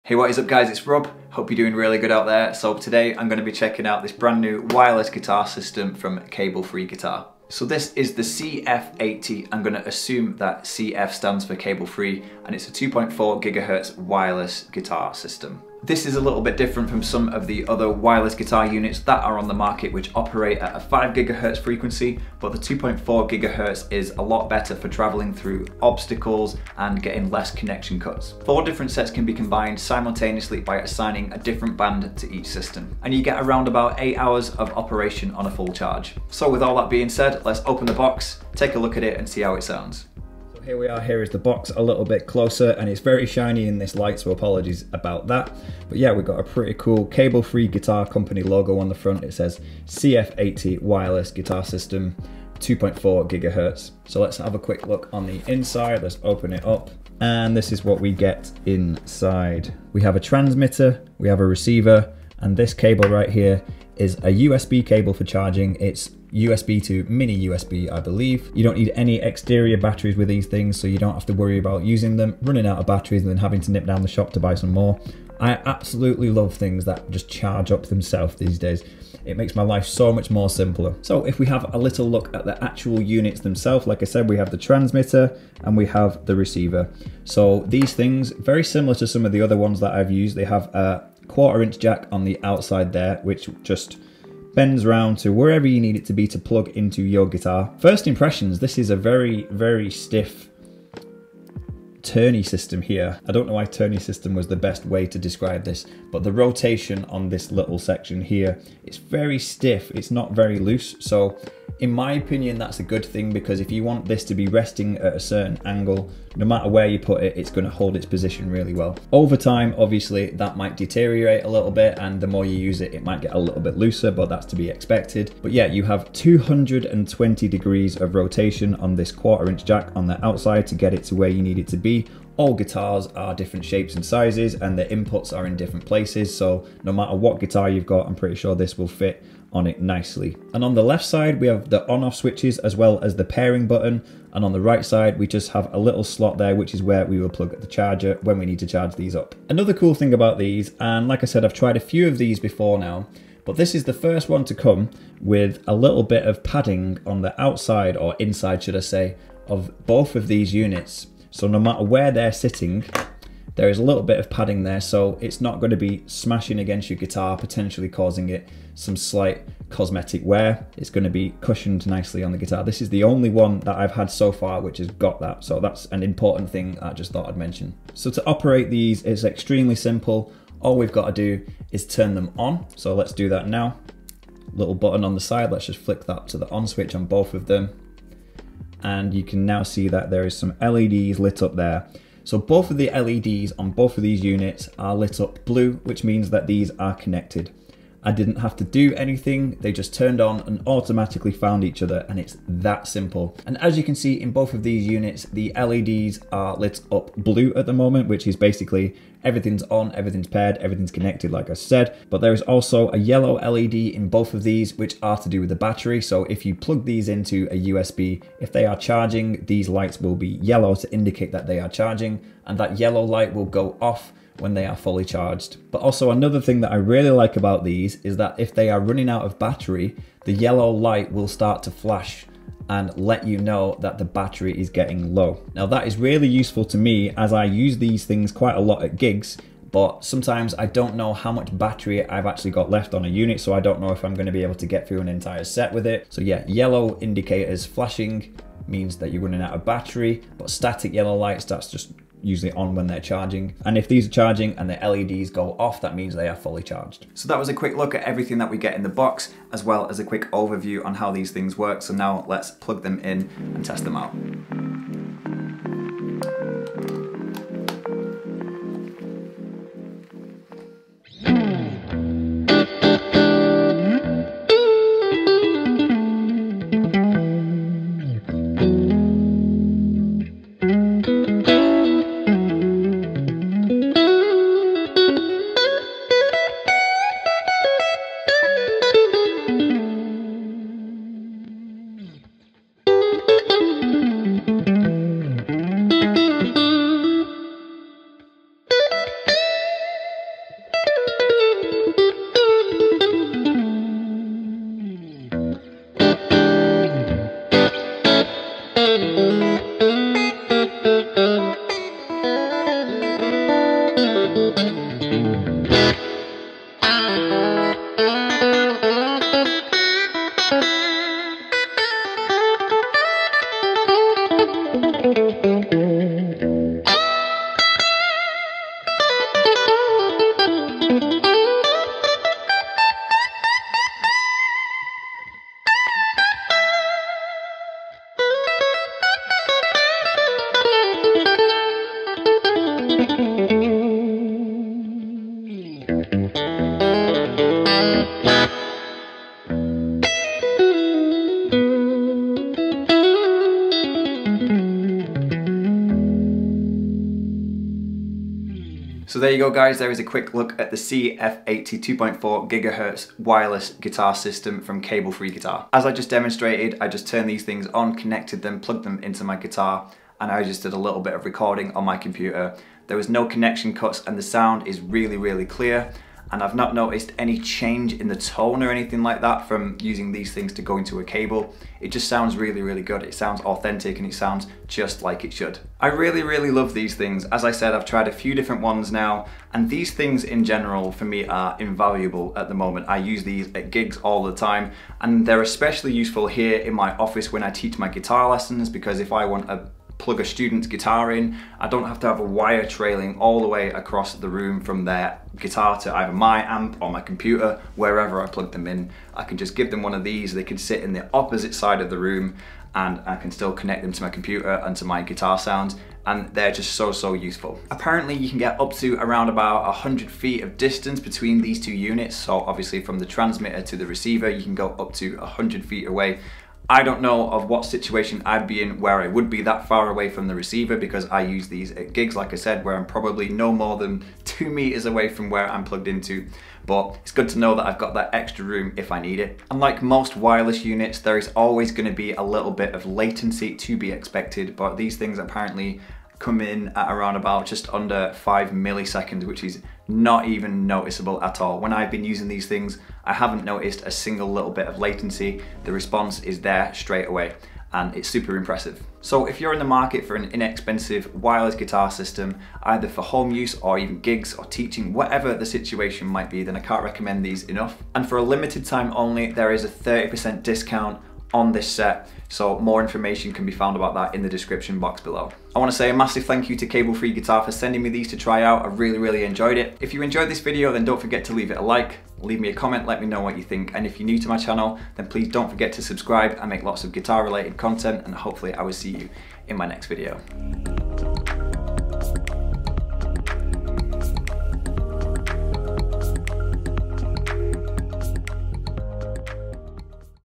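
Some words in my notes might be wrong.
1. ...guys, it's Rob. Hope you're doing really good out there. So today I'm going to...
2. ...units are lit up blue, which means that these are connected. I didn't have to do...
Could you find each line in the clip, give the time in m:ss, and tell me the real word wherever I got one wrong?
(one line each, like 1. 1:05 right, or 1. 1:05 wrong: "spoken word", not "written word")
1. 0:00 right
2. 3:14 right.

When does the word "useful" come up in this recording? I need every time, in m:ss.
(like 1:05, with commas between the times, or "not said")
3:56, 6:35, 6:57.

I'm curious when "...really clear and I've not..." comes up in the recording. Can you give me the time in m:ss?
6:15.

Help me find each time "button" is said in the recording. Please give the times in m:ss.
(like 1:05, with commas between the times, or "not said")
2:23, 3:04.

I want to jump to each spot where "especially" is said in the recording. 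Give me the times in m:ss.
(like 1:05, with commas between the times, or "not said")
6:35.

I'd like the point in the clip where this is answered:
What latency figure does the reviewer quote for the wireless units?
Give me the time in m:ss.
7:27.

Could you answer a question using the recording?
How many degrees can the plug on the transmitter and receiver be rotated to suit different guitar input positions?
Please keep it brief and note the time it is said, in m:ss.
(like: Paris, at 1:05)
220 degrees, at 2:06.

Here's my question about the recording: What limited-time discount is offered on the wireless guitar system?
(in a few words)
30%.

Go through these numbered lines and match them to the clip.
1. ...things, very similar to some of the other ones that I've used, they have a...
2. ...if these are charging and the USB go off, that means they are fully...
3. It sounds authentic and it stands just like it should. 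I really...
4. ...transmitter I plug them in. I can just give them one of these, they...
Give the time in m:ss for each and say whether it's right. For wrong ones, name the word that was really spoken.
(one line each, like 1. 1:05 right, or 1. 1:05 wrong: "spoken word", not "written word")
1. 1:27 right
2. 4:13 wrong: "LEDs", not "USB"
3. 6:23 wrong: "sounds", not "stands"
4. 6:47 wrong: "wherever", not "transmitter".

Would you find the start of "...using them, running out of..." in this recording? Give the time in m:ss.
1:11.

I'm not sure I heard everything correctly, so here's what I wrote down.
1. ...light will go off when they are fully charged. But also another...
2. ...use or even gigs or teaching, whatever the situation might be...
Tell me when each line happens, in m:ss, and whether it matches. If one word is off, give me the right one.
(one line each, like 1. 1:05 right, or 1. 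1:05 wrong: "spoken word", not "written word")
1. 3:43 right
2. 7:43 right.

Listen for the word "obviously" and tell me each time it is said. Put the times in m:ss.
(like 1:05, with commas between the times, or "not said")
1:59, 7:02.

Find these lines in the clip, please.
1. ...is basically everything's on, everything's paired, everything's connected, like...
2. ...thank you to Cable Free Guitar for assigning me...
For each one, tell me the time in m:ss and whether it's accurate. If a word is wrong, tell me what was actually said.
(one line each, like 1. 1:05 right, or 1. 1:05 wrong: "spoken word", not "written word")
1. 3:28 right
2. 7:56 wrong: "sending", not "assigning".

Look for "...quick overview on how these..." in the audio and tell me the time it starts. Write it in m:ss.
4:20.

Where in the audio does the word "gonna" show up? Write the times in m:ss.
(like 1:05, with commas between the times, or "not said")
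1:57, 4:04, 7:21.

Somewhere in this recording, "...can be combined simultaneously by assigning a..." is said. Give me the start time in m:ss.
0:29.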